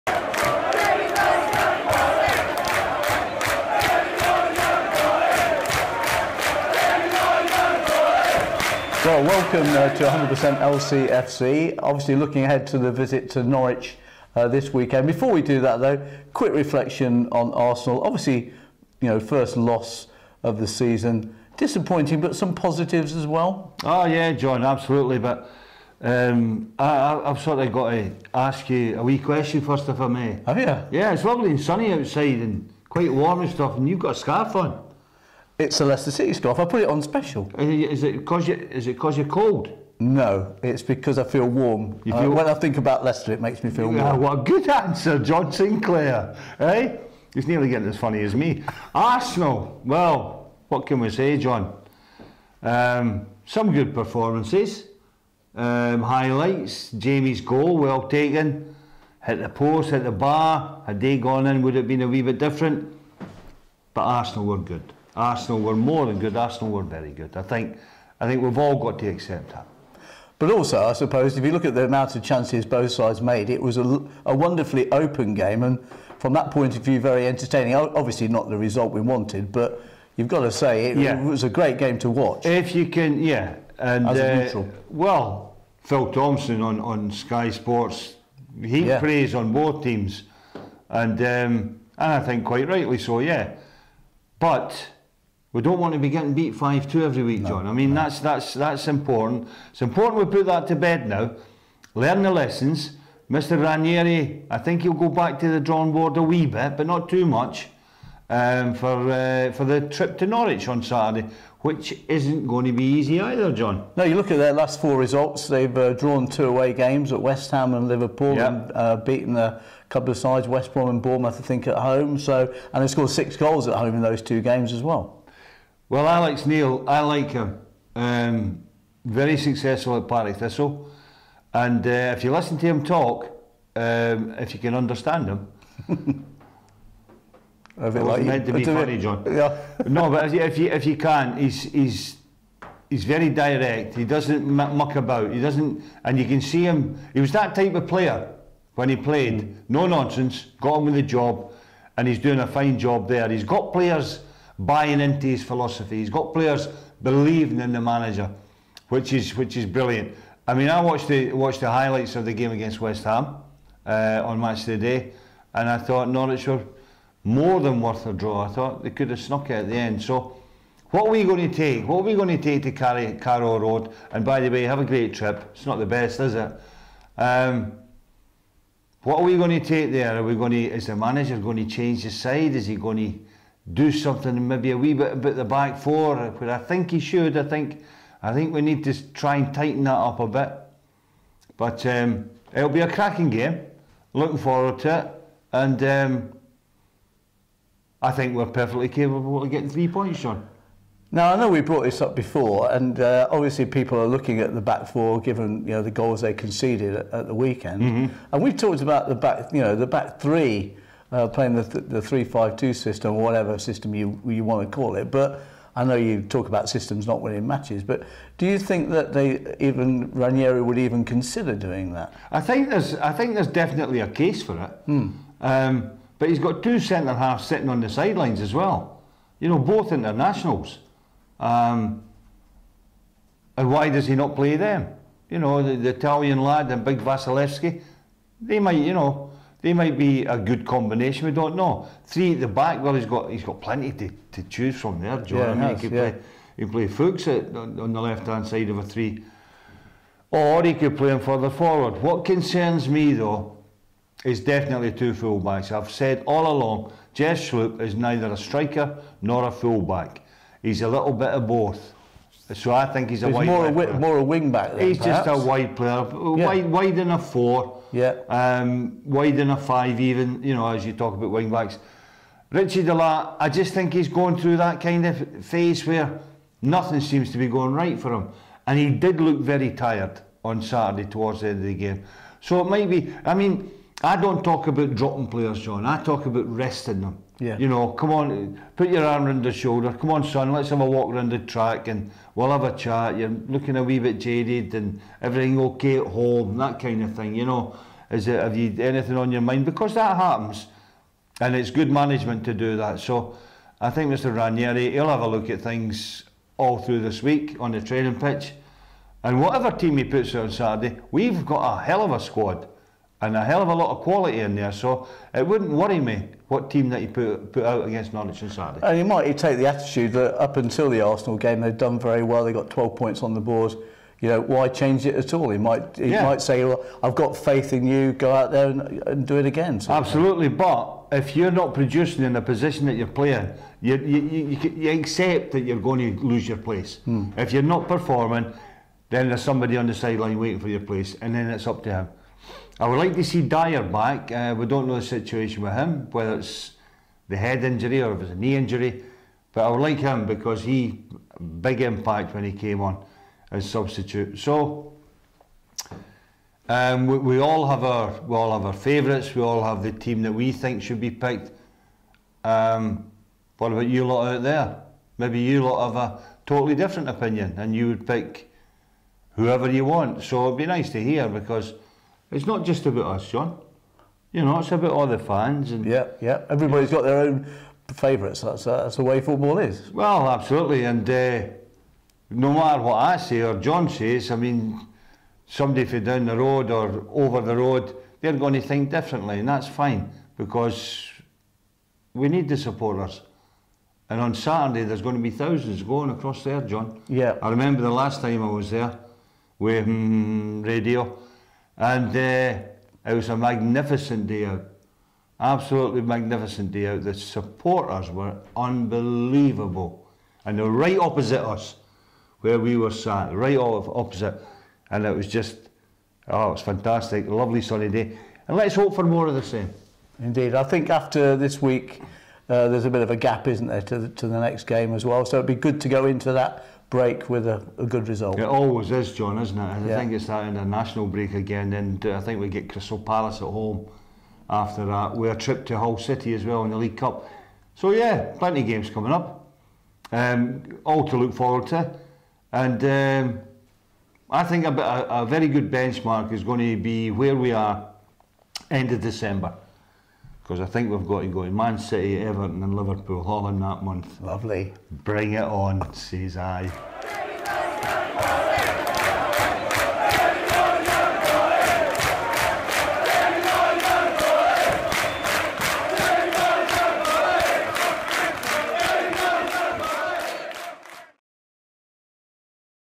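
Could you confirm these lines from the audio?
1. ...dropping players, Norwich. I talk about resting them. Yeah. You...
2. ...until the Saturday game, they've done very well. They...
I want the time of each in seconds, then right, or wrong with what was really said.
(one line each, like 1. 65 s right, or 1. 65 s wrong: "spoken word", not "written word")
1. 284 s wrong: "John", not "Norwich"
2. 320 s wrong: "Arsenal", not "Saturday".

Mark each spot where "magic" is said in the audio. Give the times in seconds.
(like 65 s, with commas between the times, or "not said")
not said.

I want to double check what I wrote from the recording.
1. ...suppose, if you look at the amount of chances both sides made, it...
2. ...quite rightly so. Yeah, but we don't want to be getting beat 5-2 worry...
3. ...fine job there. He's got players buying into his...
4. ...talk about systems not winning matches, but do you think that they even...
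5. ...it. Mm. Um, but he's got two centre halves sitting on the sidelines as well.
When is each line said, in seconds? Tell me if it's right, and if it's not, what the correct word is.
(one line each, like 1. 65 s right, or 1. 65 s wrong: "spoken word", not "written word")
1. 70 s right
2. 92 s wrong: "every", not "worry"
3. 152 s right
4. 216 s right
5. 224 s right.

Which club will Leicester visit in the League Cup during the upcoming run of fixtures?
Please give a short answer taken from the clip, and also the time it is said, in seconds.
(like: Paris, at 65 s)
Hull City, at 435 s.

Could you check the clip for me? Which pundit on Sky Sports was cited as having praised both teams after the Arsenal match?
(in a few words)
Phil Thompson.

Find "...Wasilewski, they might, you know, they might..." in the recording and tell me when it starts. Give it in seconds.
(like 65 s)
236 s.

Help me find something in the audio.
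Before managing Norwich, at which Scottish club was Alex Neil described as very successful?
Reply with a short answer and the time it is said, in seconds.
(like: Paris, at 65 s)
Partick Thistle, at 130 s.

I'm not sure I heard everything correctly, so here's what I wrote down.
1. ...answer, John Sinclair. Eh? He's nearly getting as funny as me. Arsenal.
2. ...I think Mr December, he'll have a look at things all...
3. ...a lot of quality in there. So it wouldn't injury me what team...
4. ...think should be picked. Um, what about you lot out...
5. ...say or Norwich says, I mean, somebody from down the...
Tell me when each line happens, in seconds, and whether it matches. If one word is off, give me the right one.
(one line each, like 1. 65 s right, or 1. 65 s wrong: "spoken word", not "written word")
1. 44 s right
2. 303 s wrong: "Ranieri", not "December"
3. 313 s wrong: "worry", not "injury"
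4. 360 s right
5. 383 s wrong: "John", not "Norwich".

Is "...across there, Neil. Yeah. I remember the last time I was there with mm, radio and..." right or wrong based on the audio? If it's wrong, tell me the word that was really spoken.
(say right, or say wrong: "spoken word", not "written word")
wrong: "John", not "Neil".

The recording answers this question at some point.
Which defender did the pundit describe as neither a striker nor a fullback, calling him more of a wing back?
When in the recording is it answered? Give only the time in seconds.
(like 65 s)
257 s.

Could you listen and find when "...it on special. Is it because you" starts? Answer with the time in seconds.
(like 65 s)
36 s.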